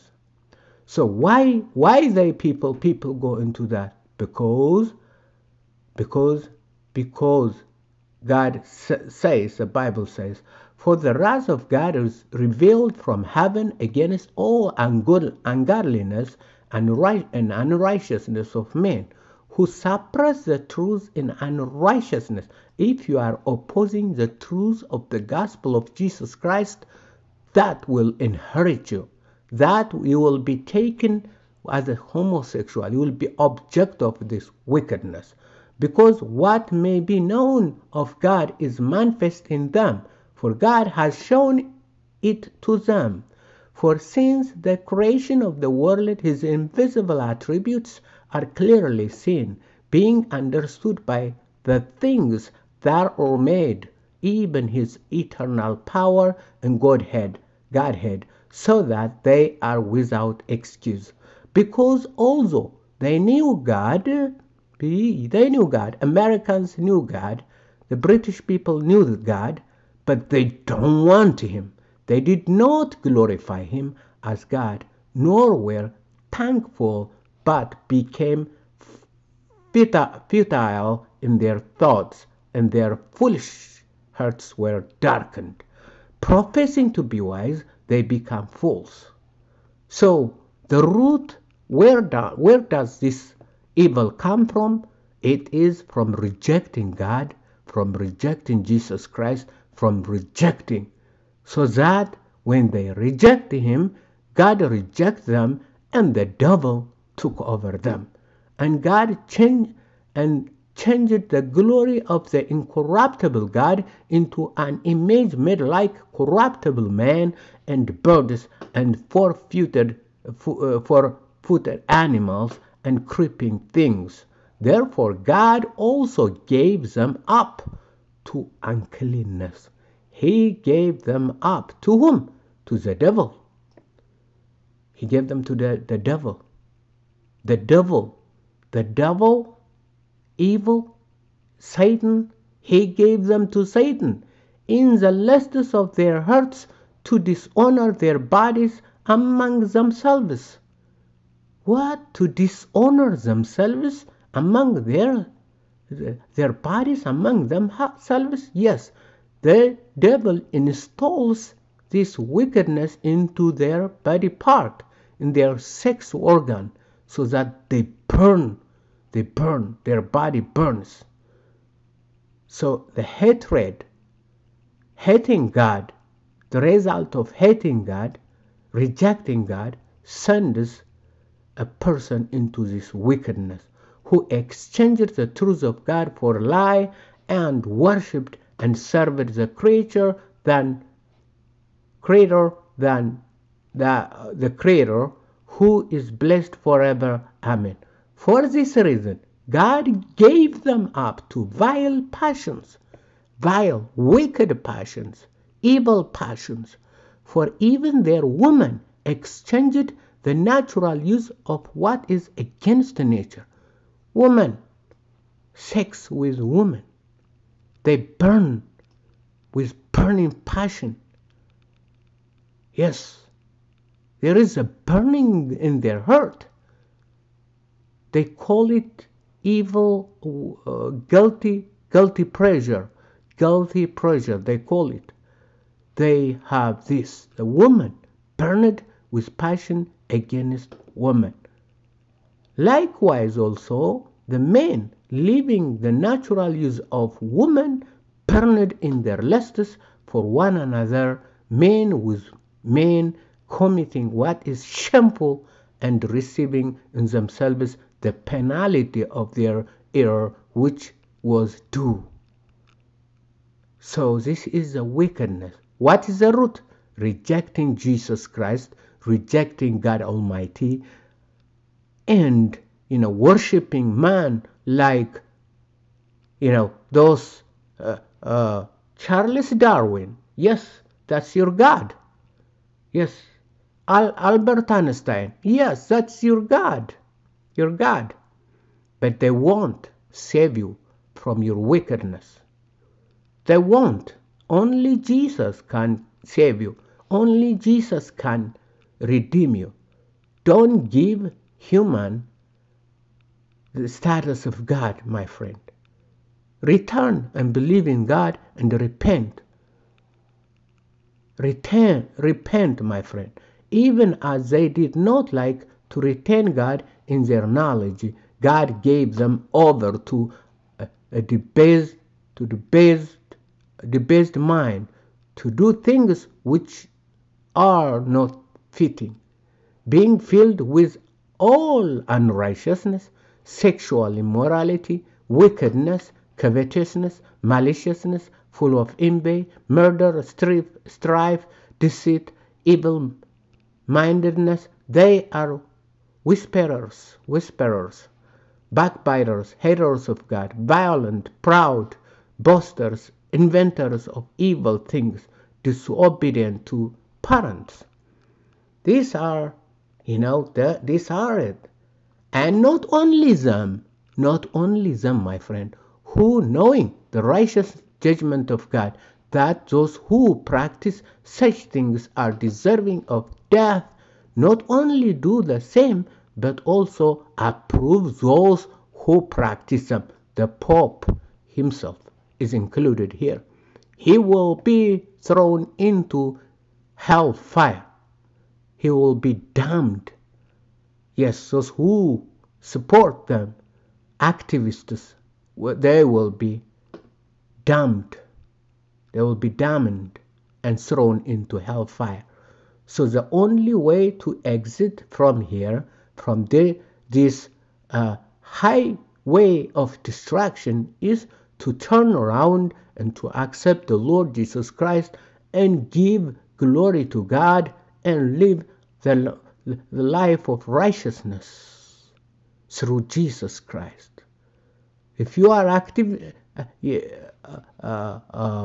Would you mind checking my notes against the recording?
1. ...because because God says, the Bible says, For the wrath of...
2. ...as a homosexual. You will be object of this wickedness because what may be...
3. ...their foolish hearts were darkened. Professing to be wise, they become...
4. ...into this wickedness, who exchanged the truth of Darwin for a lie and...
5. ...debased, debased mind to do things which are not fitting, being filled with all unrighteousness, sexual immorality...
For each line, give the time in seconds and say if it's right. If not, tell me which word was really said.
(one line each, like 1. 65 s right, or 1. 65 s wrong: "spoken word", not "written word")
1. 5 s right
2. 31 s right
3. 82 s right
4. 182 s wrong: "God", not "Darwin"
5. 322 s right.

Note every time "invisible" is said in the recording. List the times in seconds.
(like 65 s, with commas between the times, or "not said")
46 s.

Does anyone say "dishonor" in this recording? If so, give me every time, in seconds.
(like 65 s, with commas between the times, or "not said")
147 s, 152 s.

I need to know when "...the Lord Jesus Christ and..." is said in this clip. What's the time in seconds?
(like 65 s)
413 s.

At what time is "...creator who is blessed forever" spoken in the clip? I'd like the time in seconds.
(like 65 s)
194 s.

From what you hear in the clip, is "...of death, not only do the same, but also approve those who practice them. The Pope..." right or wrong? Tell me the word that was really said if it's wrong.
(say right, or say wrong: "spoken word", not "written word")
right.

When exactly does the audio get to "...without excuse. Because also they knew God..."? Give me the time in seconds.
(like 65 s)
59 s.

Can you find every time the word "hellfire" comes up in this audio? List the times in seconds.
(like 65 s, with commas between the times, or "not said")
386 s, 401 s.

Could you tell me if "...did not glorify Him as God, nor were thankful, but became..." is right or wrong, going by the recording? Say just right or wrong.
right.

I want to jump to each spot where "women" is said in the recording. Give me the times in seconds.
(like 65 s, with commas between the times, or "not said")
208 s, 240 s, 247 s.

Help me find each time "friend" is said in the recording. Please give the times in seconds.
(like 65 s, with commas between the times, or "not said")
305 s, 313 s, 365 s.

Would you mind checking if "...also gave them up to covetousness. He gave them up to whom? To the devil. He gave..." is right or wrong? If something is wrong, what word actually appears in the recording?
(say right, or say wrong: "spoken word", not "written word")
wrong: "uncleanness", not "covetousness".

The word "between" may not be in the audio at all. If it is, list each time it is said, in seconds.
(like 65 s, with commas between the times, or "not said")
not said.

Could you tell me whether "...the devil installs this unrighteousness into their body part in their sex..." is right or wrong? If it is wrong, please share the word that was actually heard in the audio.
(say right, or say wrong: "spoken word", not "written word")
wrong: "wickedness", not "unrighteousness".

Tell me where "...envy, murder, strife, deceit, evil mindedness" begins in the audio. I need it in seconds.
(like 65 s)
338 s.